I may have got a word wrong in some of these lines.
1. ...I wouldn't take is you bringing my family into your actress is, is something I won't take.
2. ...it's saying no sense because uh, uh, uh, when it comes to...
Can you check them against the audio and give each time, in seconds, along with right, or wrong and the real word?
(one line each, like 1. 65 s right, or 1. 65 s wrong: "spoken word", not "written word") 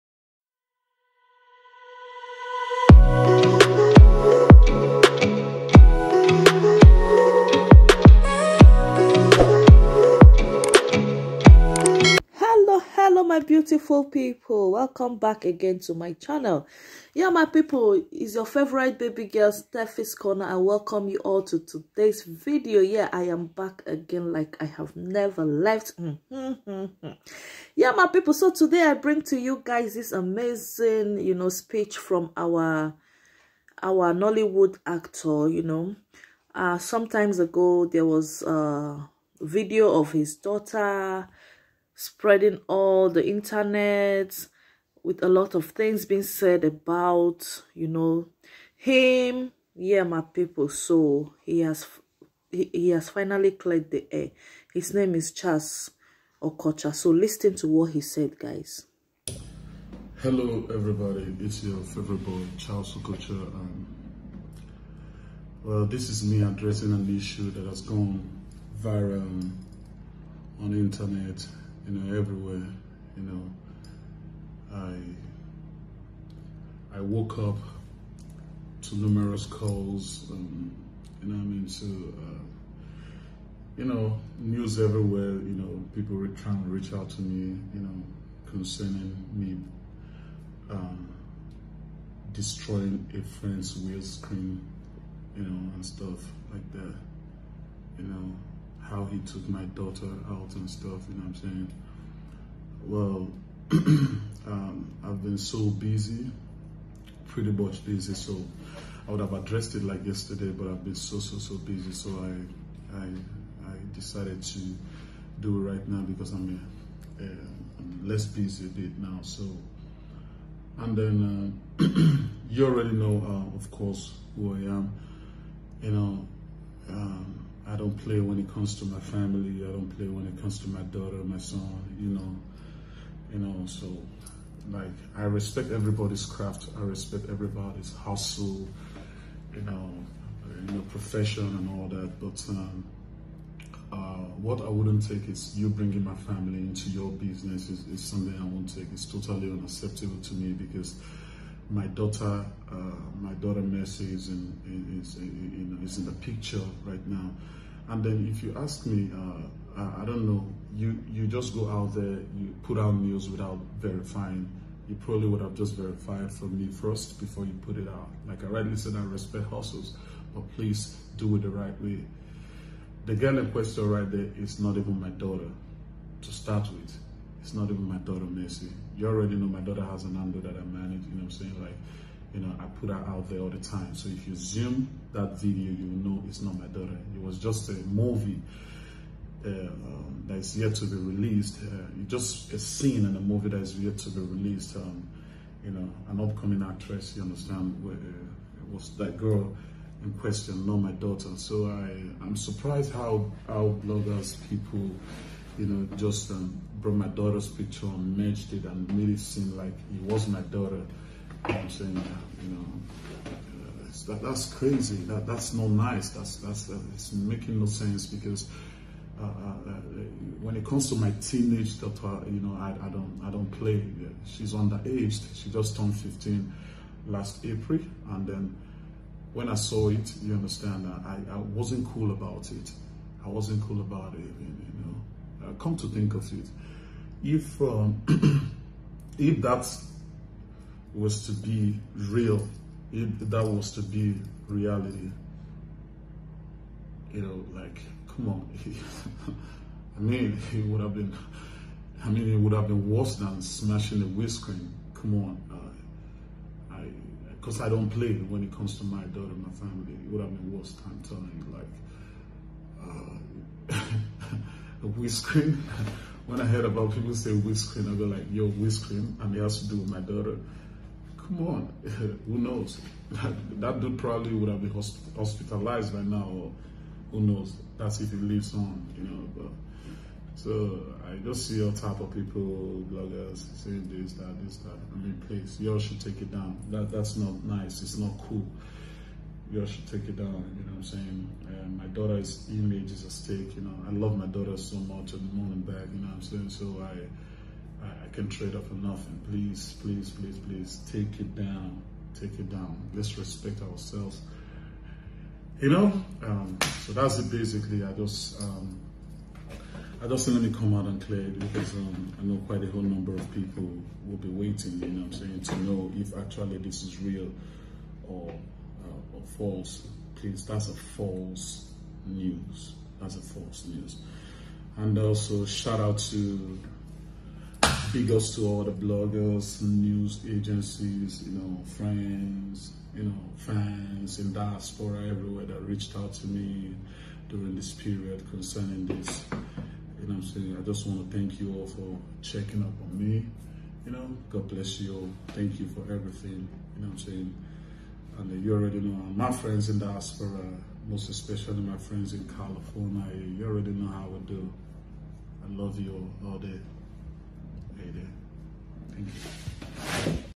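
1. 144 s wrong: "business", not "actress"
2. 216 s wrong: "making", not "saying".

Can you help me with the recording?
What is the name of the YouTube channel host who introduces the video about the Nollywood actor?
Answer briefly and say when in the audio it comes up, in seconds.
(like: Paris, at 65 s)
Stephy, at 19 s.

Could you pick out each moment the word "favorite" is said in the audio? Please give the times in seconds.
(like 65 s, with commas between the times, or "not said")
18 s, 61 s.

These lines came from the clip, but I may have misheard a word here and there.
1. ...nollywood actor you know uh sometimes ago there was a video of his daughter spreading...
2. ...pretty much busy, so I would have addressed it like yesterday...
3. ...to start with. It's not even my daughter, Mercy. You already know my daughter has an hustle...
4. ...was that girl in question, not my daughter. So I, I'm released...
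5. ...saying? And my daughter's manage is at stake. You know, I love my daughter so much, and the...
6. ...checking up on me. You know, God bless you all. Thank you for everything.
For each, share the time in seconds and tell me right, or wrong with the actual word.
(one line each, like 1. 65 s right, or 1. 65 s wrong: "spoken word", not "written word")
1. 34 s right
2. 107 s right
3. 176 s wrong: "handle", not "hustle"
4. 198 s wrong: "surprised", not "released"
5. 290 s wrong: "image", not "manage"
6. 342 s right.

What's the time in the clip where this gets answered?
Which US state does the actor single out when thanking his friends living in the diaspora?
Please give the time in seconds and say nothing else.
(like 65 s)
352 s.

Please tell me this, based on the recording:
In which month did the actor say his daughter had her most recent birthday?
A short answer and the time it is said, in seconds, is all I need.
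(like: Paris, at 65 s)
April, at 227 s.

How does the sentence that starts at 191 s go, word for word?
Uh, just a scene in a movie that is yet to be released.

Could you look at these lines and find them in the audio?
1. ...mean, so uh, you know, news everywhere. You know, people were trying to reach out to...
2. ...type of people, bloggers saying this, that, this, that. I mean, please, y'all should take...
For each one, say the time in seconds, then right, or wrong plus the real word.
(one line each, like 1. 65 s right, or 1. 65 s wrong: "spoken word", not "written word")
1. 81 s right
2. 281 s right.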